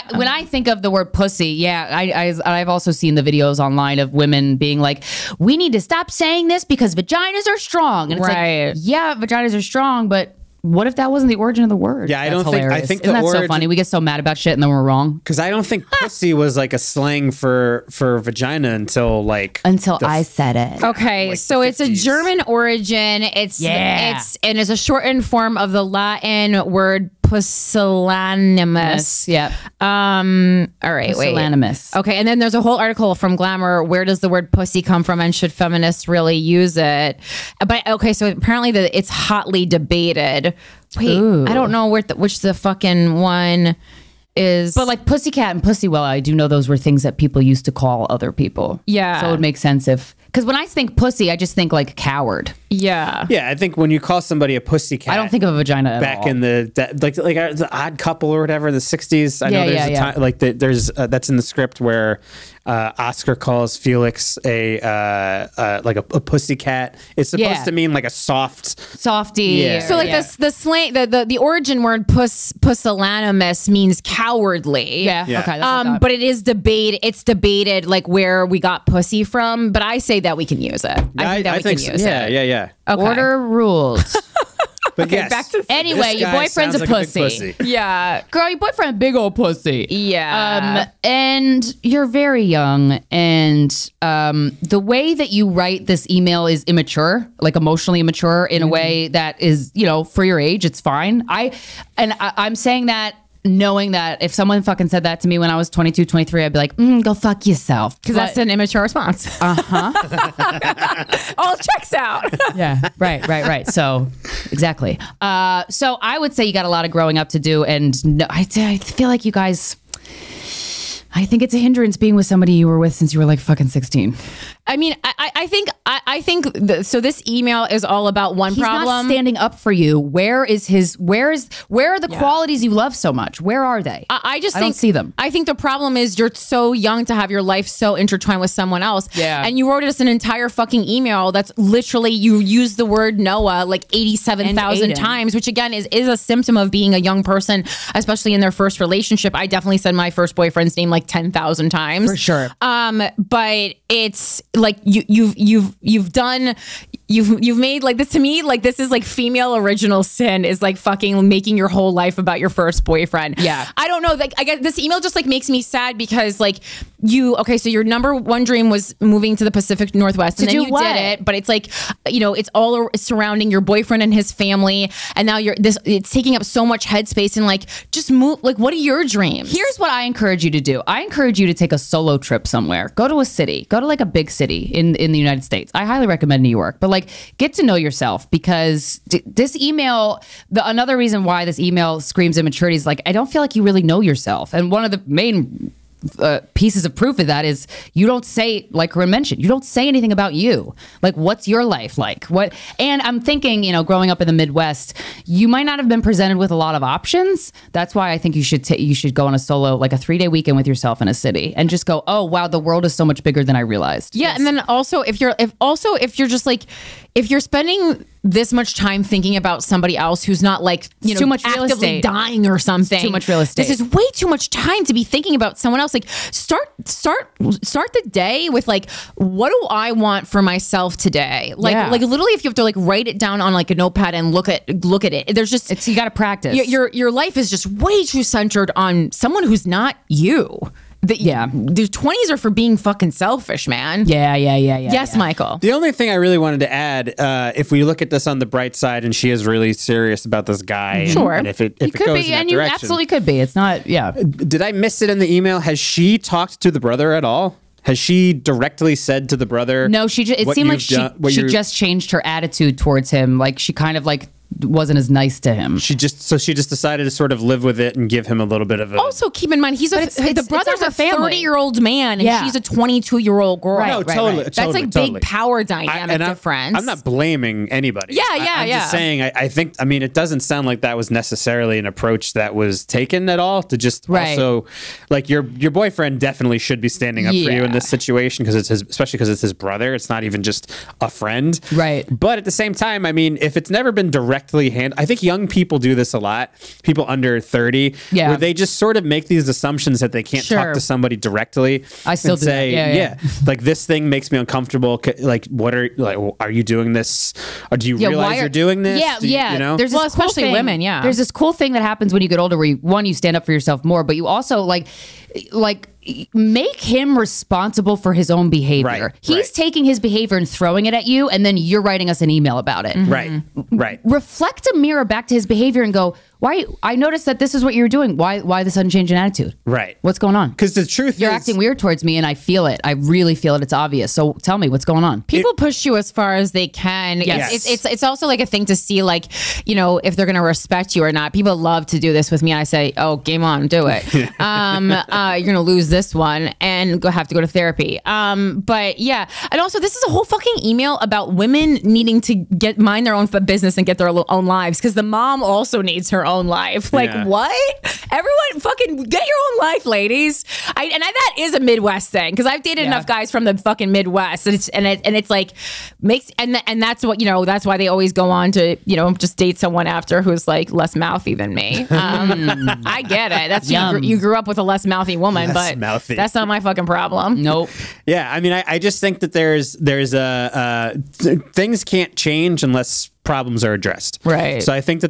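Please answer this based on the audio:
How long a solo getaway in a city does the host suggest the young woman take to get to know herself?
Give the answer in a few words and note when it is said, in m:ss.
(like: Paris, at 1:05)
three day weekend, at 3:29.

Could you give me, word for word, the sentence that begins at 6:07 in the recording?
That's why they always go on to you know just date someone after who's like less mouthy than me.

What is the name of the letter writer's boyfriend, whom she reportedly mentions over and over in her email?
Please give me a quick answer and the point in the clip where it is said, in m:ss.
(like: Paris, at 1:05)
Noah, at 2:23.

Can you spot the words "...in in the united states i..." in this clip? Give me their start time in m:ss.
3:04.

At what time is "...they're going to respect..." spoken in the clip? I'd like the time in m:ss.
5:40.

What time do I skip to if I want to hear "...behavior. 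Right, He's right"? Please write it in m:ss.
5:18.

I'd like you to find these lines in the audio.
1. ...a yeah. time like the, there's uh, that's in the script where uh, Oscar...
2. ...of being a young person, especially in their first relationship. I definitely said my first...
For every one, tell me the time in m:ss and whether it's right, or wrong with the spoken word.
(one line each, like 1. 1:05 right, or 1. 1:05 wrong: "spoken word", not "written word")
1. 0:59 right
2. 2:26 right.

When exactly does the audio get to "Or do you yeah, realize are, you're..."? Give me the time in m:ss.
5:07.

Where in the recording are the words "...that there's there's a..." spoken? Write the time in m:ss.
6:19.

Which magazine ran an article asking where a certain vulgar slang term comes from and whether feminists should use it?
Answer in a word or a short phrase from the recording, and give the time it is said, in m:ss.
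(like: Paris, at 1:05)
Glamour, at 0:33.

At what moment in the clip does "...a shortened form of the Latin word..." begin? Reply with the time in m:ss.
0:24.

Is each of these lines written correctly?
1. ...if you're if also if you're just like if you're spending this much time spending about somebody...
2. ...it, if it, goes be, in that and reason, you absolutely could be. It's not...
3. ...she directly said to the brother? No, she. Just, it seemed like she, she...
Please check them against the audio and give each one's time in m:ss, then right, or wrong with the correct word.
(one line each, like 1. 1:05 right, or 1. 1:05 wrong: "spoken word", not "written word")
1. 3:34 wrong: "thinking", not "spending"
2. 4:11 wrong: "direction", not "reason"
3. 4:17 right.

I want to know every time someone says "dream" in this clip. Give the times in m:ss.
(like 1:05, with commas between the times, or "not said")
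2:48, 2:59.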